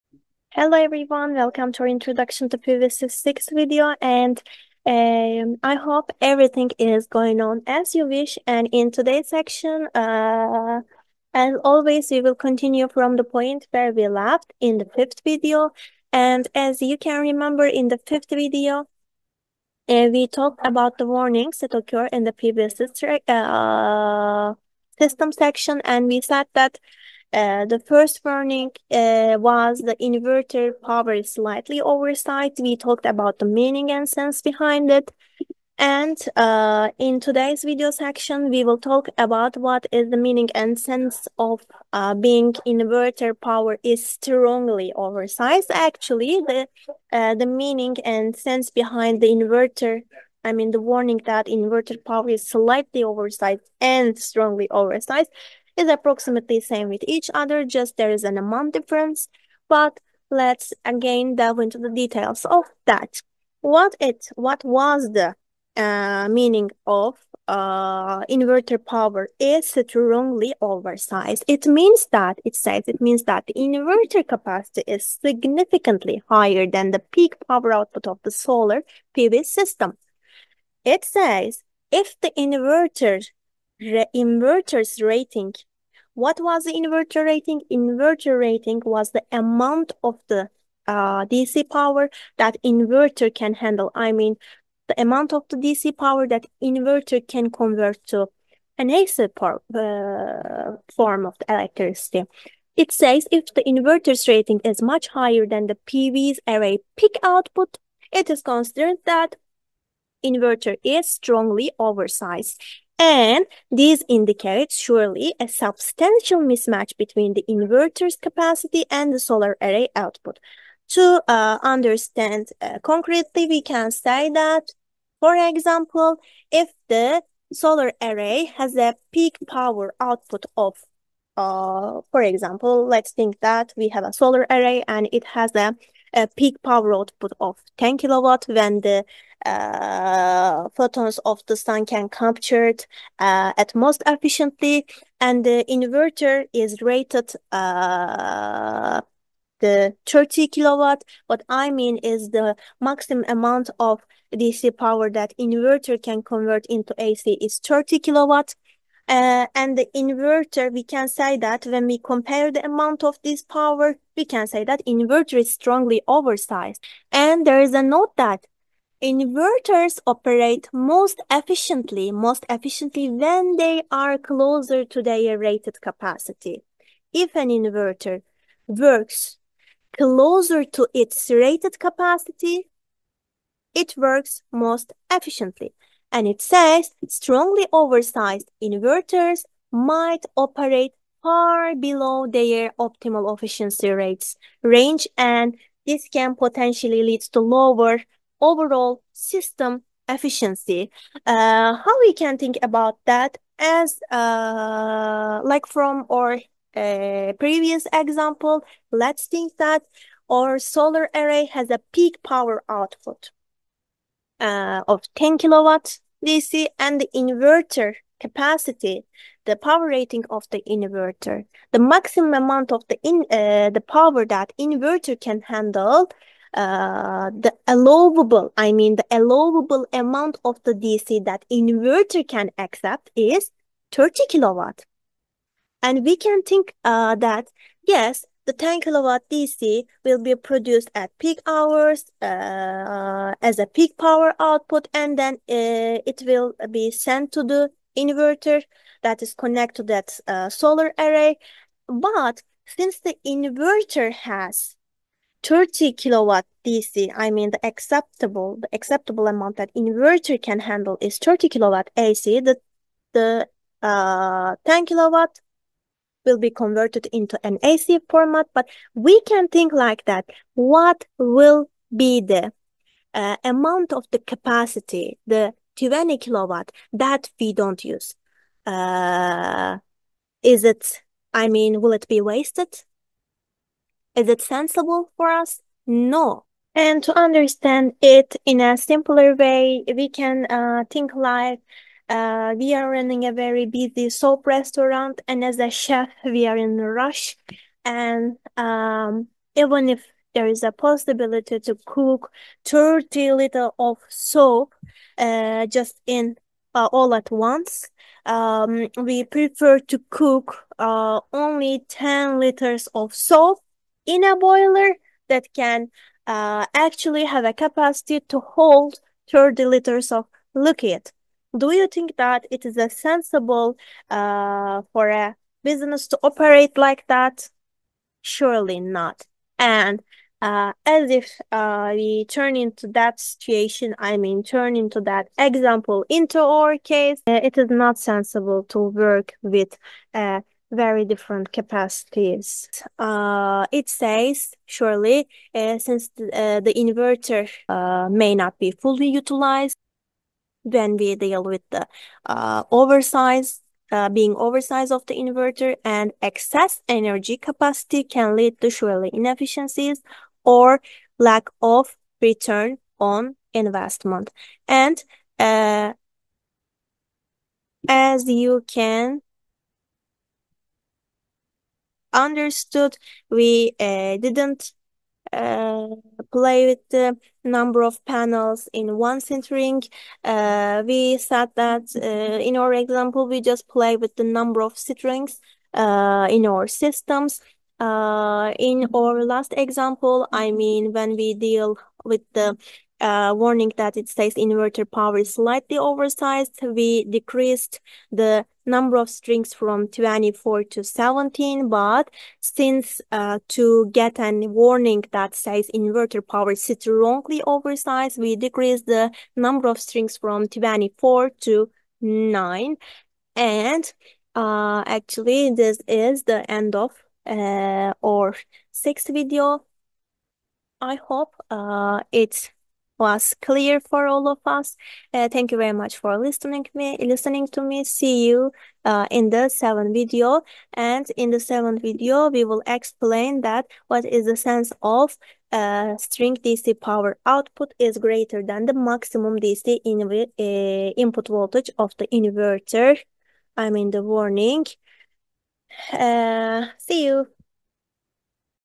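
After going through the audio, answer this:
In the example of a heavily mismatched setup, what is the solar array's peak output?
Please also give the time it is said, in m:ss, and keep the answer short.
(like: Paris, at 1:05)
10 kilowatt, at 2:17.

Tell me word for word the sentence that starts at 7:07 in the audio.
See you uh, in the seventh video.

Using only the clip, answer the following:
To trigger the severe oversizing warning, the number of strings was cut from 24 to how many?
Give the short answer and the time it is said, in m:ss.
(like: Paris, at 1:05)
9, at 6:52.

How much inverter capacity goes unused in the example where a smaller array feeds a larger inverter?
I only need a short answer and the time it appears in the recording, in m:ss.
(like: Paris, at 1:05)
20 kilowatt, at 4:35.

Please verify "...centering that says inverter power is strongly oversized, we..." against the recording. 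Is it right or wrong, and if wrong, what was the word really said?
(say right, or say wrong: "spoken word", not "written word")
wrong: "warning", not "centering".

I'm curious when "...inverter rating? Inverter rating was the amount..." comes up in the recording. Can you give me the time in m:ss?
1:26.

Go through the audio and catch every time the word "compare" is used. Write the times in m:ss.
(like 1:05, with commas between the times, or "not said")
2:41.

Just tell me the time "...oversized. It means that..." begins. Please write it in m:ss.
1:10.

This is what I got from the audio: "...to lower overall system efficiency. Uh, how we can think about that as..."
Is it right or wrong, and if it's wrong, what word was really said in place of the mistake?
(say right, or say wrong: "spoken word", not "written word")
right.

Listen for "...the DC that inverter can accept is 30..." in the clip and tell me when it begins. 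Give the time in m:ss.
3:50.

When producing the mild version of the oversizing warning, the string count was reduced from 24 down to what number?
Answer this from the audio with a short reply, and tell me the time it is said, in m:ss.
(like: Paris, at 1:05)
17, at 6:40.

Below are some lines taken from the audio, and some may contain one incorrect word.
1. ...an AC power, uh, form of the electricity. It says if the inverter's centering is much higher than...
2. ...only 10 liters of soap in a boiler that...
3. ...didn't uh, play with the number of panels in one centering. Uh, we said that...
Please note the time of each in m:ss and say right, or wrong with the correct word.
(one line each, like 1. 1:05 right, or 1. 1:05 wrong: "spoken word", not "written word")
1. 1:38 wrong: "rating", not "centering"
2. 5:11 right
3. 6:14 right.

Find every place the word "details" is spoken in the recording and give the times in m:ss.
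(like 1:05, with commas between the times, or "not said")
1:01.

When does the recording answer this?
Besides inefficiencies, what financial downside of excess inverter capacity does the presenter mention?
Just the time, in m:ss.
6:01.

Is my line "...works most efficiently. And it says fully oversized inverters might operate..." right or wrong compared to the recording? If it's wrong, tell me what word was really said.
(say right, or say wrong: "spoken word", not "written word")
wrong: "strongly", not "fully".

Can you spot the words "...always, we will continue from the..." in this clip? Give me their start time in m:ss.
0:11.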